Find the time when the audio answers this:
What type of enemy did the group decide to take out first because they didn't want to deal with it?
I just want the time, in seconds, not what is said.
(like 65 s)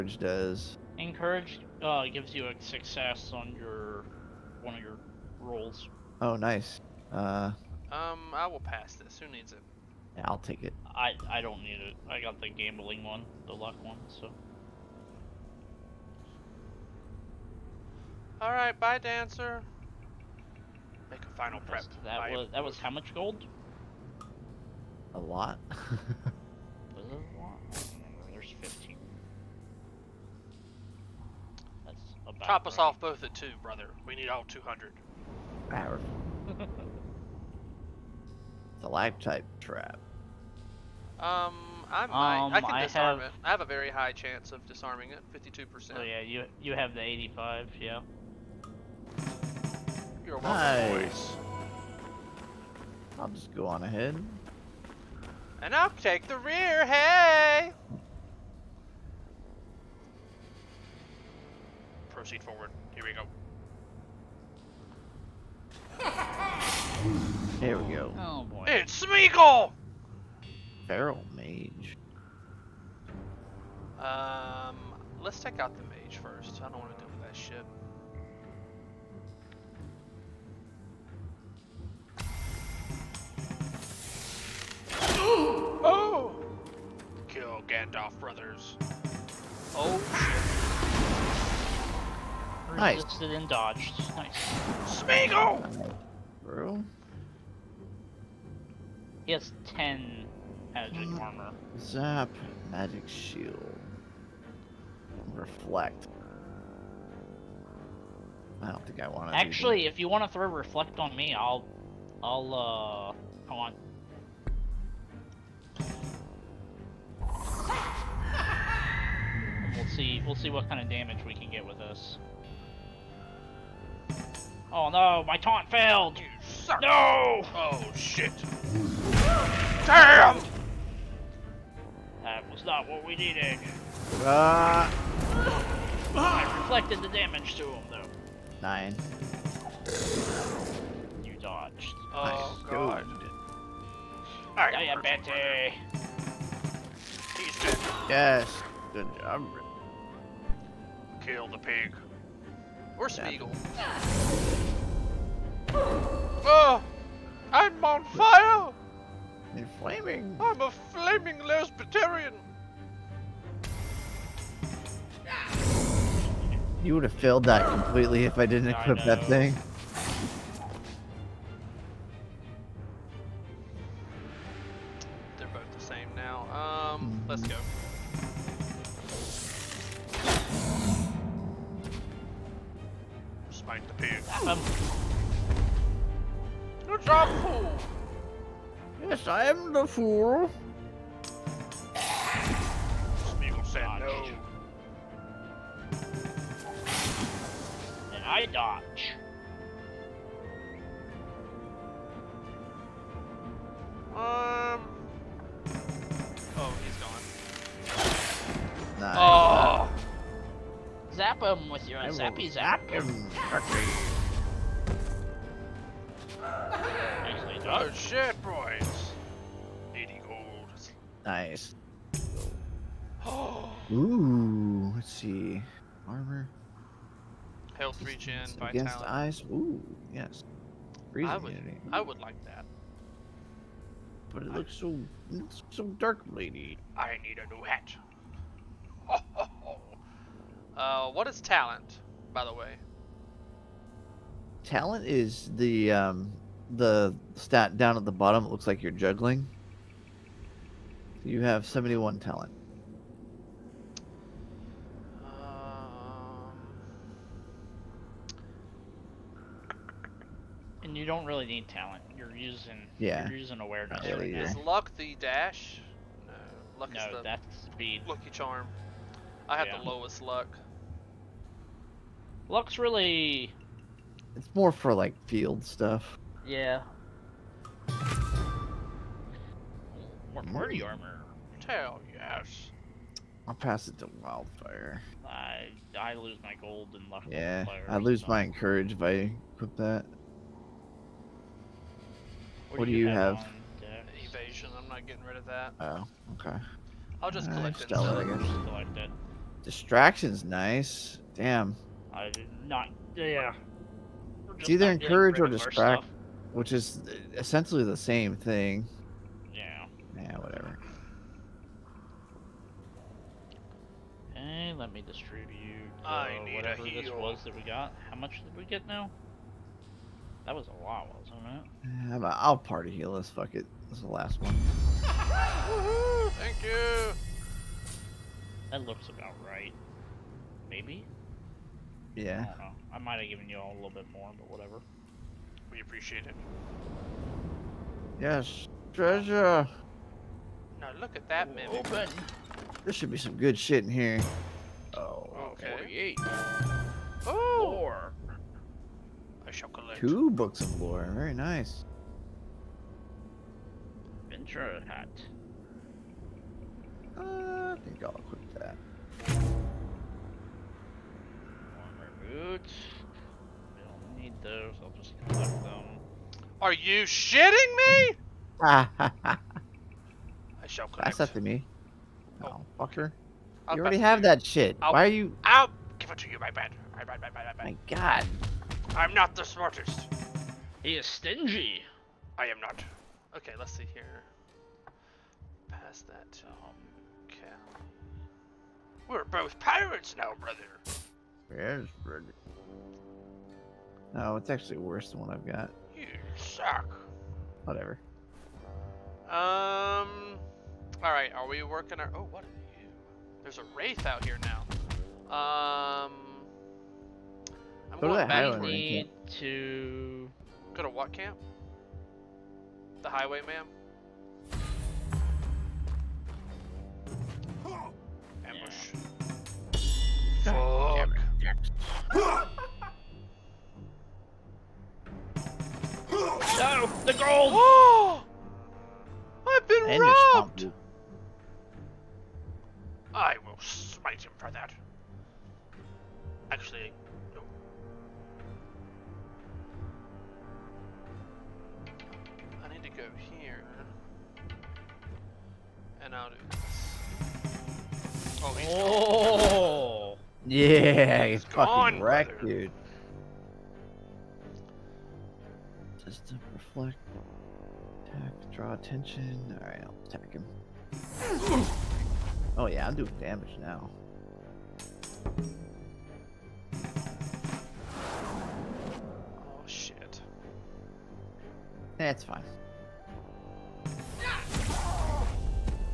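70 s.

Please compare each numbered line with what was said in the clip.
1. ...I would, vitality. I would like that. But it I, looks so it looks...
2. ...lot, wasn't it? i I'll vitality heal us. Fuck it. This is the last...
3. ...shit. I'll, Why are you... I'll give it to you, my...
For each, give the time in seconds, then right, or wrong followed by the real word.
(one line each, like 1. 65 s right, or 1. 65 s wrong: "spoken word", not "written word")
1. 231 s wrong: "immunity", not "vitality"
2. 320 s wrong: "party", not "vitality"
3. 374 s right.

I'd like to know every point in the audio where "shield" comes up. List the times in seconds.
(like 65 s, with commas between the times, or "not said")
103 s.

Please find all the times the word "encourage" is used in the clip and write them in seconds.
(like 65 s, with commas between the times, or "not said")
0 s, 288 s, 304 s.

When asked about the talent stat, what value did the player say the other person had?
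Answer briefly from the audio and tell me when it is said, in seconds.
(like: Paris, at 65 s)
71, at 251 s.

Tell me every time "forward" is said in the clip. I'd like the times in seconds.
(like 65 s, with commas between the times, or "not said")
62 s.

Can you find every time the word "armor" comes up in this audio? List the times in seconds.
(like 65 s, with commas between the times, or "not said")
101 s, 226 s, 280 s, 361 s.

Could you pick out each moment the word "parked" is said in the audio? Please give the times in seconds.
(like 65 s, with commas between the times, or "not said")
not said.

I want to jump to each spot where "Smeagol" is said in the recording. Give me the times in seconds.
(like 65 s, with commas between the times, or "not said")
69 s, 95 s, 191 s.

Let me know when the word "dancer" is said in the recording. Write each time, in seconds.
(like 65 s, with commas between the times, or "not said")
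18 s.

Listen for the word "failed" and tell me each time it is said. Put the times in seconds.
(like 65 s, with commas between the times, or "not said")
125 s, 167 s.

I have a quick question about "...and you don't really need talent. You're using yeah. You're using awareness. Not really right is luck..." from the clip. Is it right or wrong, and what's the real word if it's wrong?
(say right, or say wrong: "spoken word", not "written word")
right.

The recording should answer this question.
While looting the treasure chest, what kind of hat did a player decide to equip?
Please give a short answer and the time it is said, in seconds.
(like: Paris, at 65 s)
Venture hat, at 354 s.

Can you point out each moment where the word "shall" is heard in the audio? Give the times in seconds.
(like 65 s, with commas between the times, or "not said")
349 s, 370 s.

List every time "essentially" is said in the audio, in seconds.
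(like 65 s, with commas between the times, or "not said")
307 s.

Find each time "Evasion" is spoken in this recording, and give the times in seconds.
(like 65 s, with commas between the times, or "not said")
294 s.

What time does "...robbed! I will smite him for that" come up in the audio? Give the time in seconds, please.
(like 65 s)
430 s.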